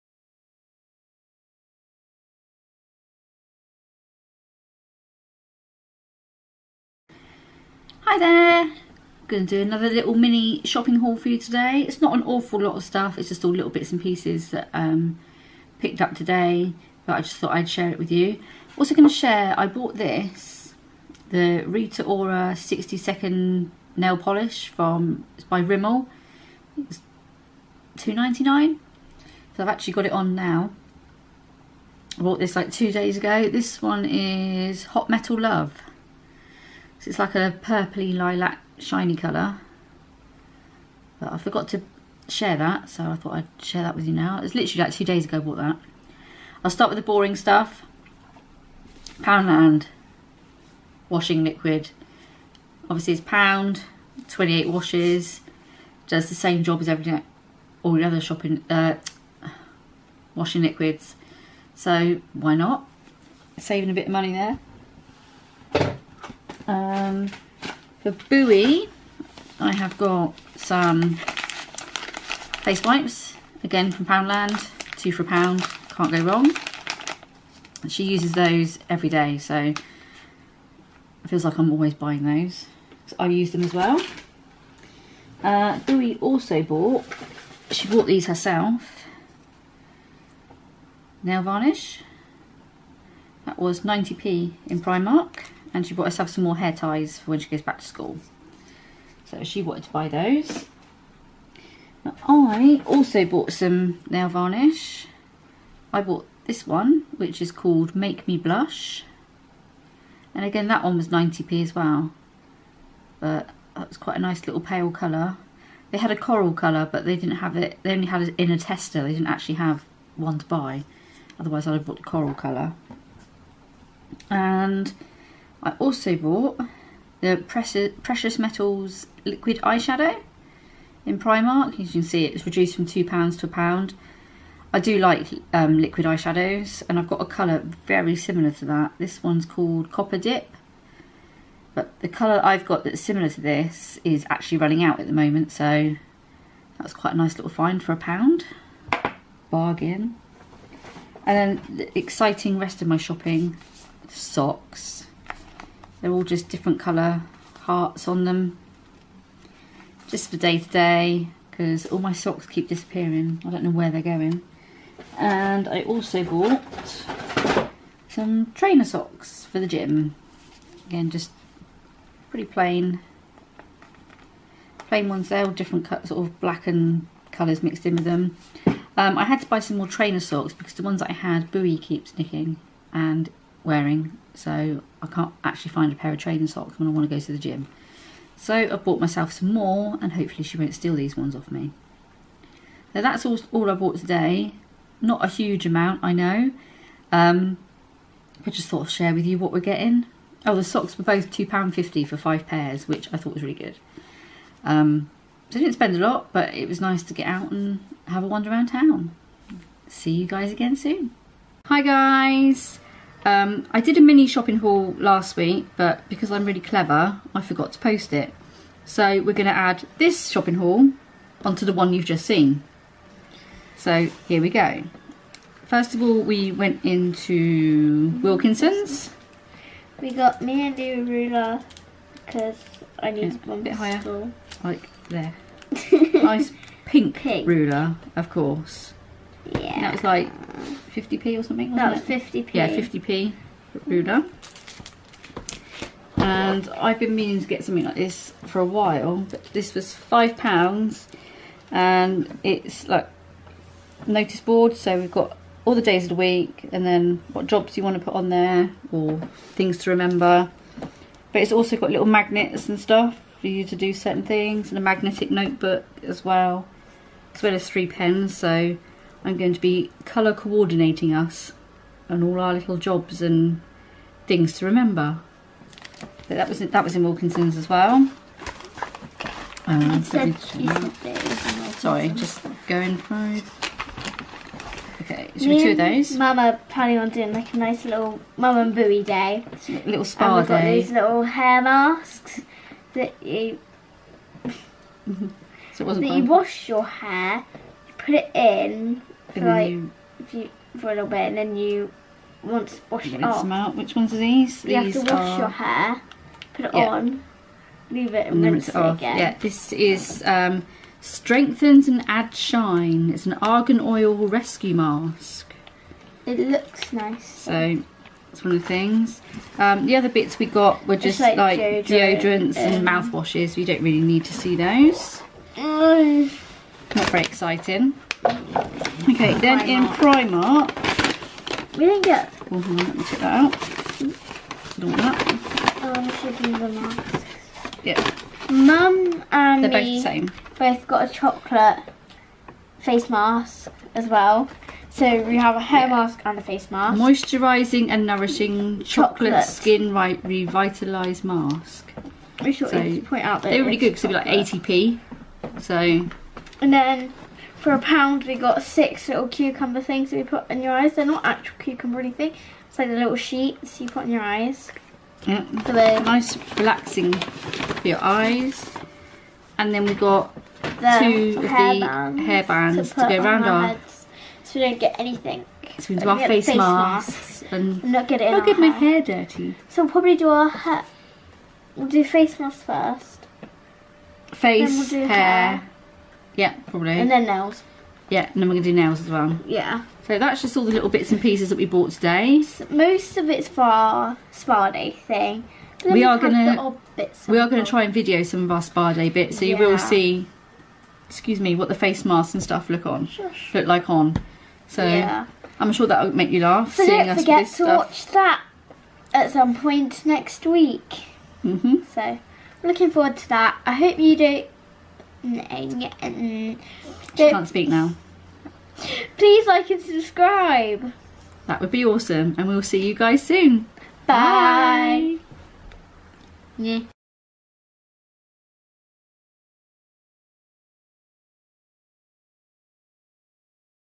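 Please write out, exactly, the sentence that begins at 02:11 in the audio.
As you can see, it's reduced from £2 to a pound.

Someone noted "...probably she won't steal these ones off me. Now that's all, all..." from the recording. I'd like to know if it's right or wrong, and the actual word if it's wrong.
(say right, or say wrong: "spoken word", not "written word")
wrong: "hopefully", not "probably".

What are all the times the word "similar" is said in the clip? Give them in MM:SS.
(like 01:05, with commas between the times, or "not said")
02:18, 02:23.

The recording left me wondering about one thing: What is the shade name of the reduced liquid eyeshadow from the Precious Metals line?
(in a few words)
Copper Dip.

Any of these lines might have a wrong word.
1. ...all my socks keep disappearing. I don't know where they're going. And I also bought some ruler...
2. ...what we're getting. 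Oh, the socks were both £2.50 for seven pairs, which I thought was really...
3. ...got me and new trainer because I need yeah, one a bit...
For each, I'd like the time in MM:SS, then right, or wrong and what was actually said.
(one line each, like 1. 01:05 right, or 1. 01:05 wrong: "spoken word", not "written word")
1. 02:41 wrong: "trainer", not "ruler"
2. 03:19 wrong: "five", not "seven"
3. 03:50 wrong: "ruler", not "trainer".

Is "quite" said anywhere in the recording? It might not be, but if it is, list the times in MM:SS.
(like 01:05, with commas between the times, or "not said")
01:53, 02:26.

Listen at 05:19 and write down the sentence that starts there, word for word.
Um, the other bits we got were just like, like, deodorant, deodorants and mouthwashes.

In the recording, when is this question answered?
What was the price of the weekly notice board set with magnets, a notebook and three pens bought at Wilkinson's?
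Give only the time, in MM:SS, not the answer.
04:10.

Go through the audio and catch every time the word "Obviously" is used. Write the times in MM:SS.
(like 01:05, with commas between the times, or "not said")
00:52.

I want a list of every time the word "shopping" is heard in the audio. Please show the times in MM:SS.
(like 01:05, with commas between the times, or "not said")
00:10, 00:58, 02:32, 03:34, 03:40.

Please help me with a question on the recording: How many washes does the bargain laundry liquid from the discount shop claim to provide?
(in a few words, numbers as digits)
28.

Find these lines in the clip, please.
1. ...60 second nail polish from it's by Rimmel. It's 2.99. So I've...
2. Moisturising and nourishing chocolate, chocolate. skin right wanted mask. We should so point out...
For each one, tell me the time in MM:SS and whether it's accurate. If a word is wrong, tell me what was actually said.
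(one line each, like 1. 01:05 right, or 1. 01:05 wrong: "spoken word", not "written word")
1. 00:22 right
2. 05:46 wrong: "revitalised", not "wanted".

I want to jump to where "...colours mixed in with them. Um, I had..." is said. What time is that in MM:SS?
02:57.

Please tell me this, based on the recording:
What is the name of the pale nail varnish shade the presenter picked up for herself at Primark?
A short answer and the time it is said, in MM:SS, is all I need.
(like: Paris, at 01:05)
Make Me Blush, at 01:47.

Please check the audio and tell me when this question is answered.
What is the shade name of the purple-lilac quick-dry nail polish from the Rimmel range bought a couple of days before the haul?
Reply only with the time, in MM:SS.
00:34.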